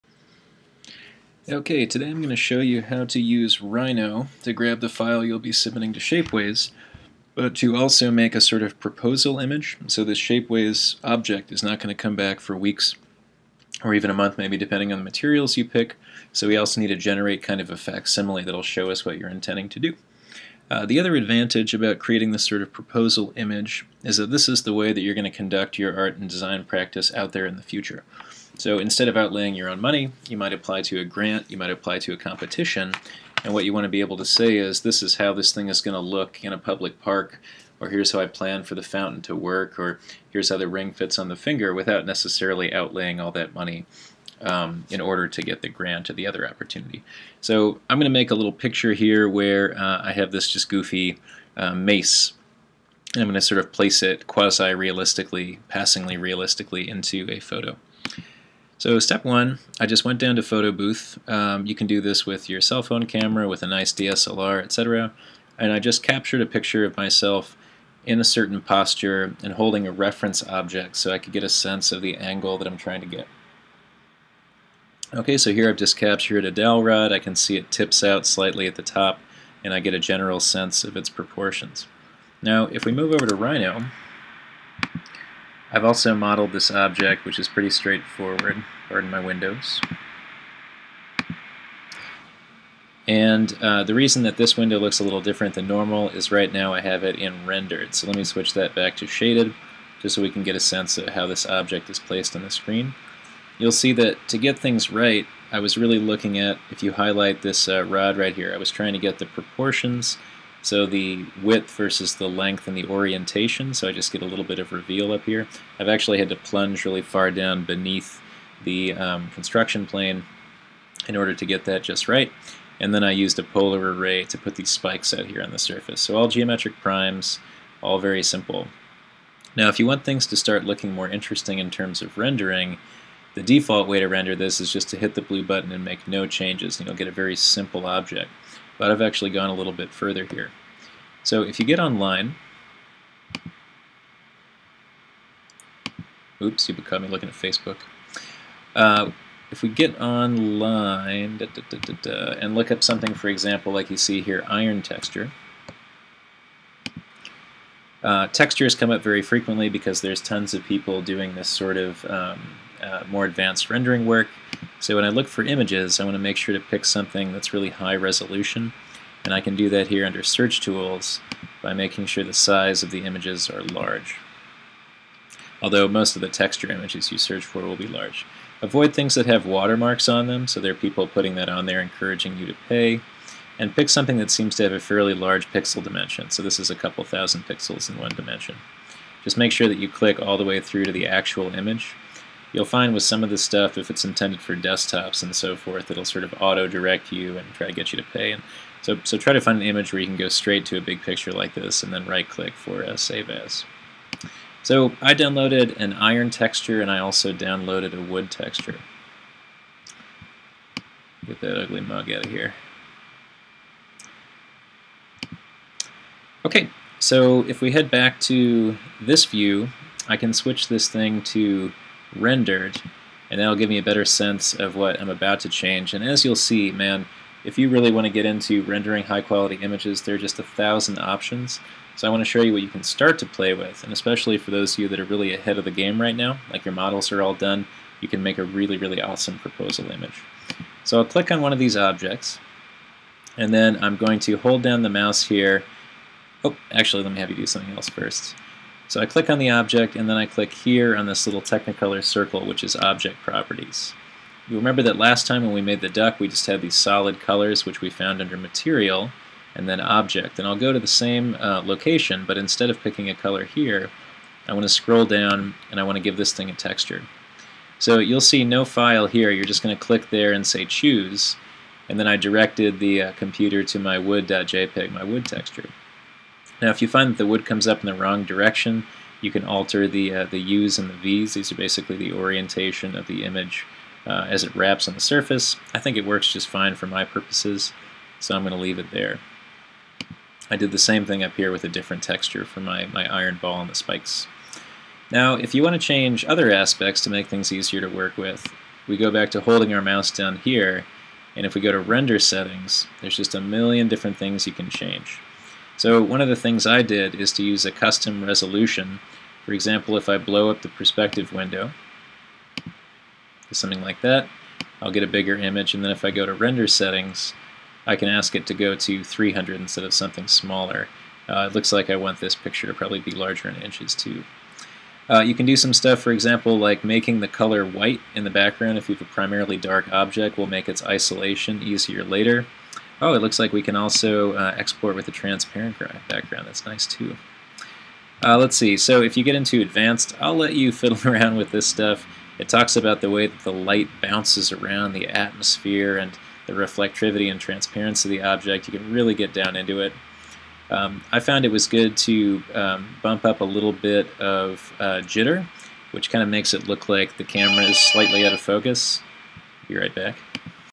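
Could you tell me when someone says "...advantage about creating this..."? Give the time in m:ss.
0:21.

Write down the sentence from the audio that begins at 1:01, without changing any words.
Um, you can do this with your cell phone camera, with a nice DSLR, etc.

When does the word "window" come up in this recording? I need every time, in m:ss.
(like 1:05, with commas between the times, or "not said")
1:29, 1:34, 5:11.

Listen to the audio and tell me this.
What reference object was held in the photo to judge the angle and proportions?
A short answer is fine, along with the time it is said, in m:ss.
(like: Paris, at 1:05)
A dowel rod, at 1:16.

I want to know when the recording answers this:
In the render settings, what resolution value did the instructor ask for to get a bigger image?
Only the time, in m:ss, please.
5:19.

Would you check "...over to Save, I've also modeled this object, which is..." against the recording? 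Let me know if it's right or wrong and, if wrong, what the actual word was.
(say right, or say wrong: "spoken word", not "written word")
wrong: "Rhino", not "Save".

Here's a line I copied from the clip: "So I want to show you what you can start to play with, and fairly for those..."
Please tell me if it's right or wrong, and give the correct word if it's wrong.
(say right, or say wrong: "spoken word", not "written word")
wrong: "especially", not "fairly".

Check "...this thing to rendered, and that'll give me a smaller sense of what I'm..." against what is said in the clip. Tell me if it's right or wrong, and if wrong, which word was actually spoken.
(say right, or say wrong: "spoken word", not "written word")
wrong: "better", not "smaller".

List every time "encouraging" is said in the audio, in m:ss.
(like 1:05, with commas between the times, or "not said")
3:01.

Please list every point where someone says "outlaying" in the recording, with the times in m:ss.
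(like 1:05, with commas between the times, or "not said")
0:29, 0:42.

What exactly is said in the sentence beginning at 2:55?
Although most of the texture images you search for will be large.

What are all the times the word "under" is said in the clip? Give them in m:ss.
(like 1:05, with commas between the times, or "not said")
2:50, 4:18.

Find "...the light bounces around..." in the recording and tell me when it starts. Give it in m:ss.
5:43.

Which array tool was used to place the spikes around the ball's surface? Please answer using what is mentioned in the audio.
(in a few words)
Polar array.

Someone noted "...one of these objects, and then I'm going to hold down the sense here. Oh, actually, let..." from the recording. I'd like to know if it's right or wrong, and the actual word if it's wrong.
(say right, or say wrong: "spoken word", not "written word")
wrong: "mouse", not "sense".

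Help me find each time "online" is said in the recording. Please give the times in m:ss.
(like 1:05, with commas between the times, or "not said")
2:21, 2:30.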